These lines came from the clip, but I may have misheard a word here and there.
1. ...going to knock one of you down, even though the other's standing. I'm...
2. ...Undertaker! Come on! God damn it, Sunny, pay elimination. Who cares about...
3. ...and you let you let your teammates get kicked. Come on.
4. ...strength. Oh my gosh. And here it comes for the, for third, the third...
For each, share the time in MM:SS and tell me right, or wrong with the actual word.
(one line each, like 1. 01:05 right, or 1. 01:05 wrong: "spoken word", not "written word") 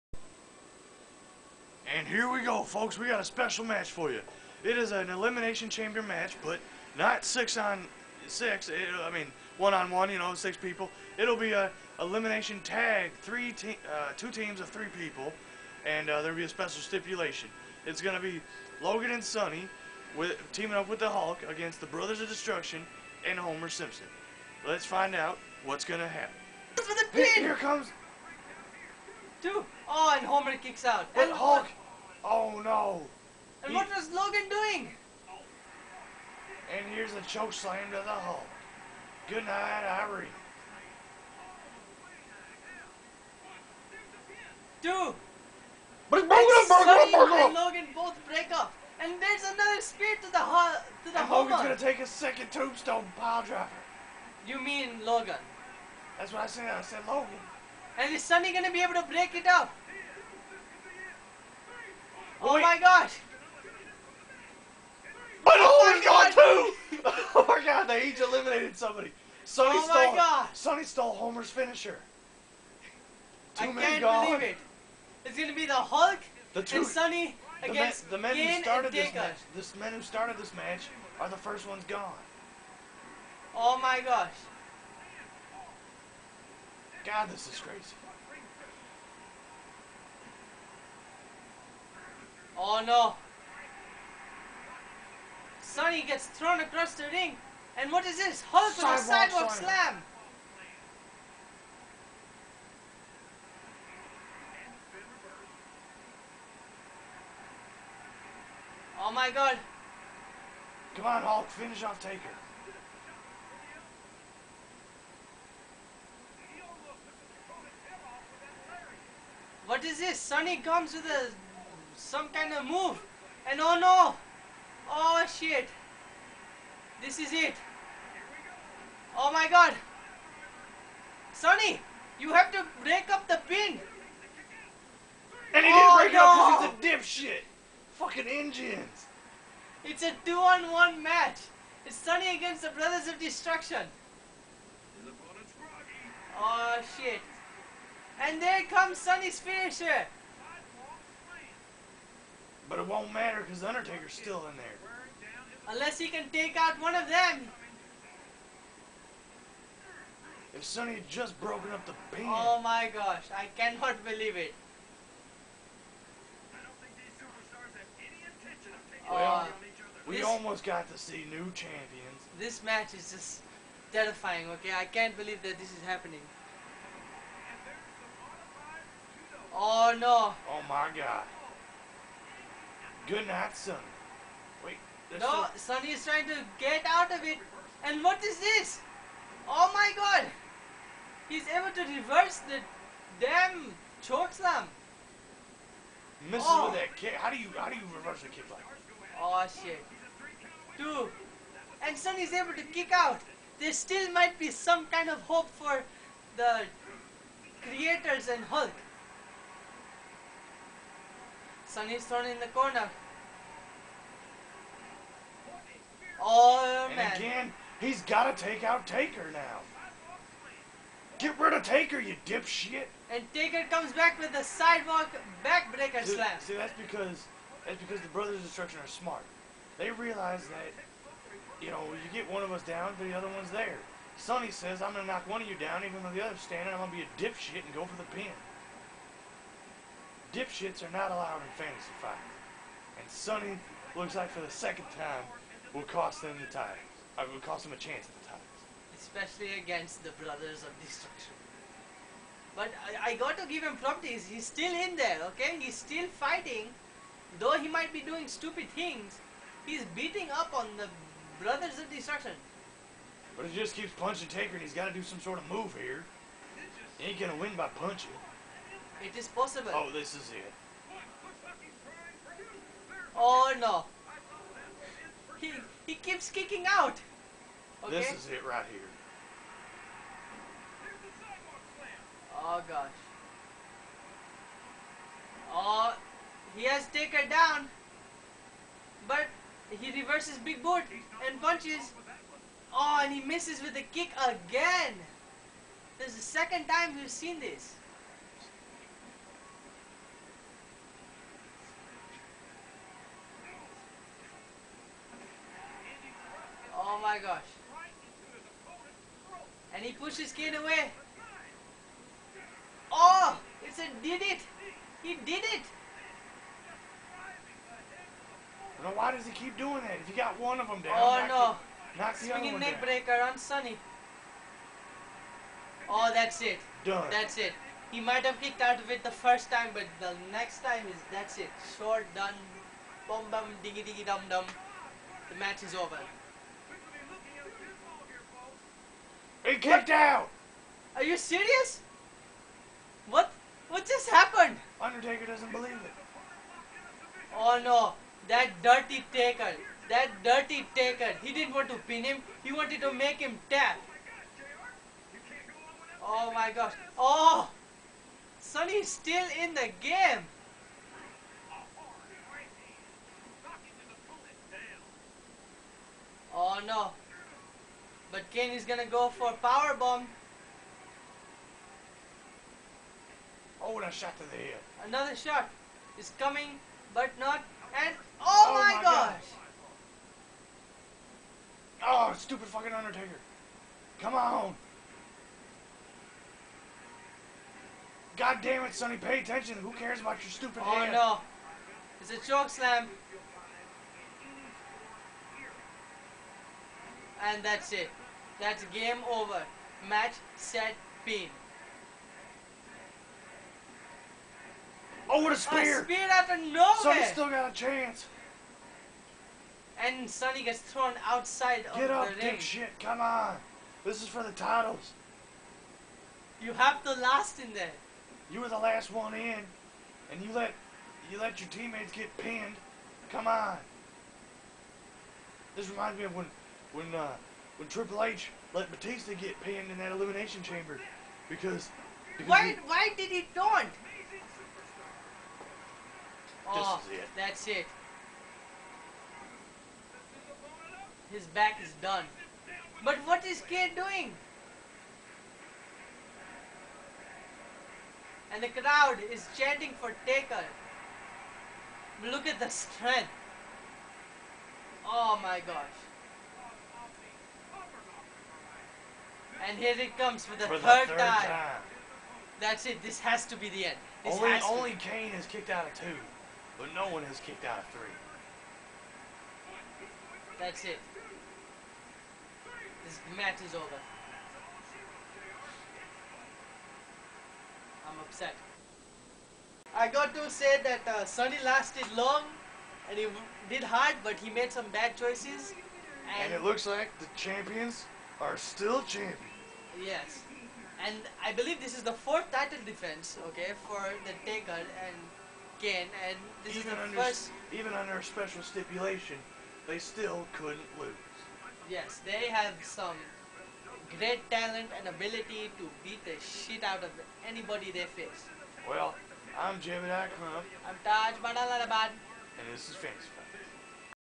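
1. 03:54 right
2. 06:22 wrong: "attention", not "elimination"
3. 07:00 wrong: "pinned", not "kicked"
4. 07:32 right.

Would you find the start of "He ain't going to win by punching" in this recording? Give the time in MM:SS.
04:26.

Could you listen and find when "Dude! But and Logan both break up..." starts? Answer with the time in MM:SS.
00:44.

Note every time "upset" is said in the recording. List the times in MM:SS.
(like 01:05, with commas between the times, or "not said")
07:58.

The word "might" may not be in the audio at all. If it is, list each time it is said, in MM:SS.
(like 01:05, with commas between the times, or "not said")
03:24, 04:17, 05:27.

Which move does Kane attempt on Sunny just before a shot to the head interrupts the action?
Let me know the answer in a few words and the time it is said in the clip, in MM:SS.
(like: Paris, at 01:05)
power bomb, at 06:09.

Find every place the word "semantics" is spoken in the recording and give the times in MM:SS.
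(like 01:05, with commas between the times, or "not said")
not said.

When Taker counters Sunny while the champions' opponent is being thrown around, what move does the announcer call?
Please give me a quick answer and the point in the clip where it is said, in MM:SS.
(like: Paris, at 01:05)
sidewalk backbreaker, at 03:44.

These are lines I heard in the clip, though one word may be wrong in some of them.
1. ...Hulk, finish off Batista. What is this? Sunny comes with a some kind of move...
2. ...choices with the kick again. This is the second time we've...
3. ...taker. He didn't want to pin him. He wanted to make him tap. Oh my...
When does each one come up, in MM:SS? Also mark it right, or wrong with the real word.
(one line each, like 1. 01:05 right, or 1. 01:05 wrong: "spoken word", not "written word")
1. 01:51 wrong: "Taker", not "Batista"
2. 04:53 wrong: "misses", not "choices"
3. 05:50 right.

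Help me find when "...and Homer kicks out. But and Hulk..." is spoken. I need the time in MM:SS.
00:30.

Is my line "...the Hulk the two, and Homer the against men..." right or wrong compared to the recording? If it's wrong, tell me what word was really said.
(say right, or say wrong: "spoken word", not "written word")
wrong: "Sunny", not "Homer".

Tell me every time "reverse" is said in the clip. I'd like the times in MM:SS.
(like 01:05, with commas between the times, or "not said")
03:11, 03:17, 04:49.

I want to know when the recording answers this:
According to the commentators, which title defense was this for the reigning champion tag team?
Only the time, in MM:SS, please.
08:11.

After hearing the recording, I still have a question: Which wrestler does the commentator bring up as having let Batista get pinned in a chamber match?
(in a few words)
Triple H.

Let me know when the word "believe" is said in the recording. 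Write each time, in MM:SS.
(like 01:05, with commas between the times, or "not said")
01:14, 02:44, 02:55, 05:45, 08:11.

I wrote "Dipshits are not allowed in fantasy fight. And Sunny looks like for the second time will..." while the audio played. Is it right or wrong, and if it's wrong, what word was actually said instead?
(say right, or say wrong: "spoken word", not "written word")
right.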